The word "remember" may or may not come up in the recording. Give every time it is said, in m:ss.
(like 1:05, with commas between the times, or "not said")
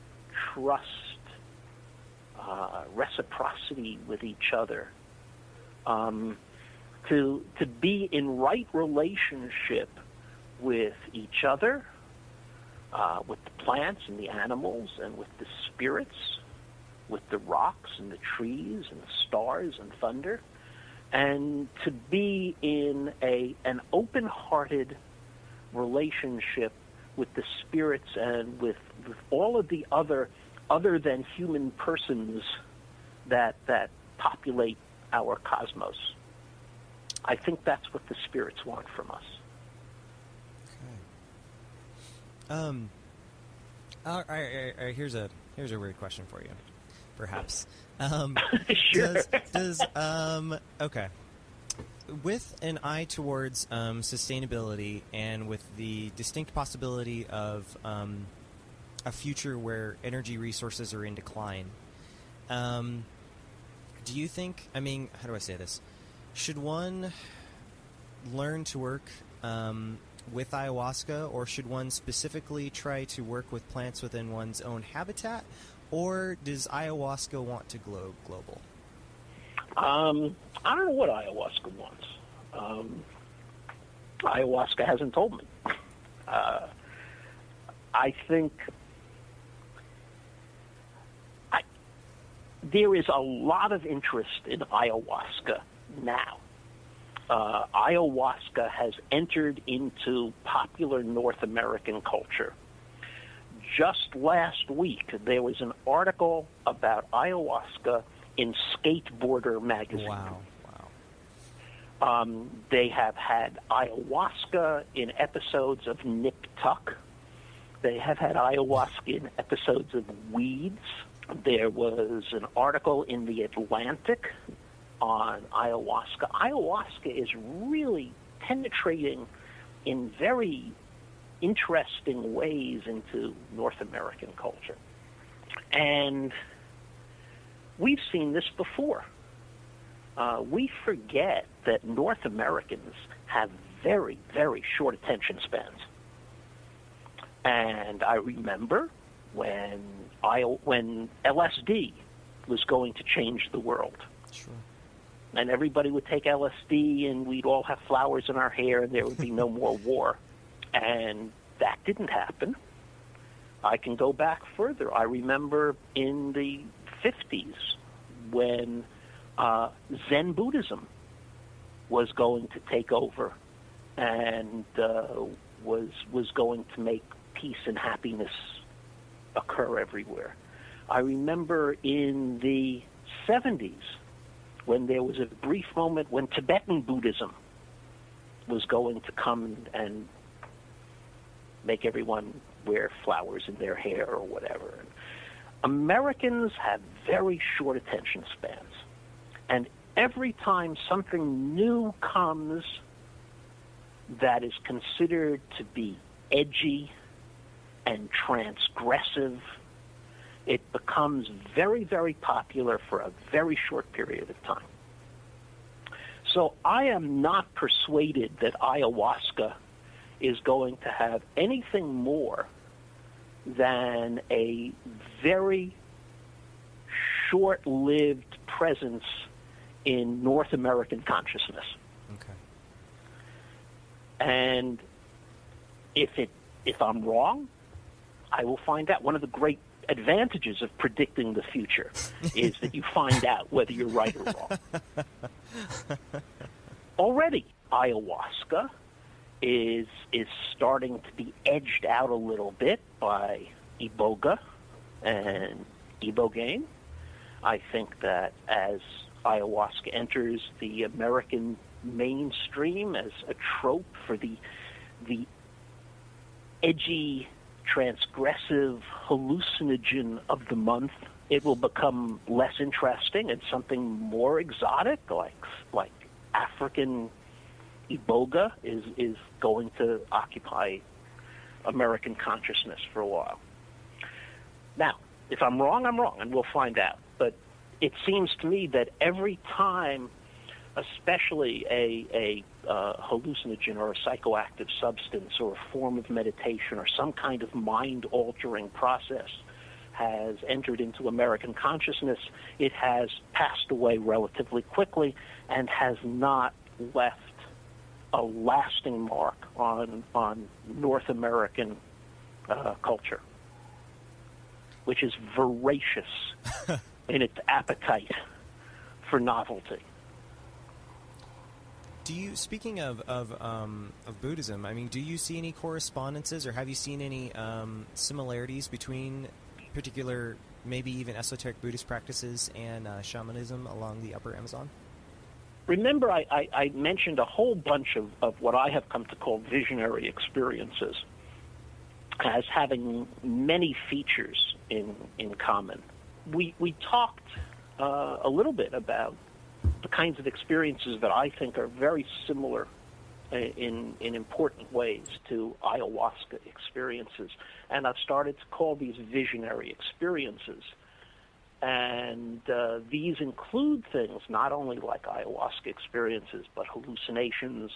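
2:28, 2:45, 3:00, 5:35.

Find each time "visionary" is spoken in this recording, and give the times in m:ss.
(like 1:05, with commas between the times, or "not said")
5:39, 5:58.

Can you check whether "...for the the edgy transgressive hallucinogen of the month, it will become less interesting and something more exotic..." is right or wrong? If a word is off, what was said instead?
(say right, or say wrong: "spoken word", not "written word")
right.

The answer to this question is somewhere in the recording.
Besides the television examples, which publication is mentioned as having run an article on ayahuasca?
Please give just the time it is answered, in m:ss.
2:03.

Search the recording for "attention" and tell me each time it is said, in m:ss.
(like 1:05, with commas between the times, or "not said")
2:24, 3:17.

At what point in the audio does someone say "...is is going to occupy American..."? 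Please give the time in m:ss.
4:38.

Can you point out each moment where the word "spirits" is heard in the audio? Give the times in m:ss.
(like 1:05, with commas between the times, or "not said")
0:15, 0:27, 0:38.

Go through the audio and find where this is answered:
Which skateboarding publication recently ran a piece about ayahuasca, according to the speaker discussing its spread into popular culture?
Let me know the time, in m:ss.
1:48.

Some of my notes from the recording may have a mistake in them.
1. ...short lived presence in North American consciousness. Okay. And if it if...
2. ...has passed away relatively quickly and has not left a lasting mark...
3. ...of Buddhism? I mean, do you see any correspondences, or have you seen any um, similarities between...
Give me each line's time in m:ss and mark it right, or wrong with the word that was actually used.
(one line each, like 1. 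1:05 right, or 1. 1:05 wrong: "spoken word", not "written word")
1. 3:47 right
2. 5:02 right
3. 5:24 right.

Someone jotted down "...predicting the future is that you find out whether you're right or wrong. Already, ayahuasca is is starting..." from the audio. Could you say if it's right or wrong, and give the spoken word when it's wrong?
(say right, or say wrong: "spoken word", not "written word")
right.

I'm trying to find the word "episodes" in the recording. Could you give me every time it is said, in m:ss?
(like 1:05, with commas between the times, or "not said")
1:55, 1:59.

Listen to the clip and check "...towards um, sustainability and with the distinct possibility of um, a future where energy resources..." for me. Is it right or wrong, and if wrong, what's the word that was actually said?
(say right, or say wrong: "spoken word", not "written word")
right.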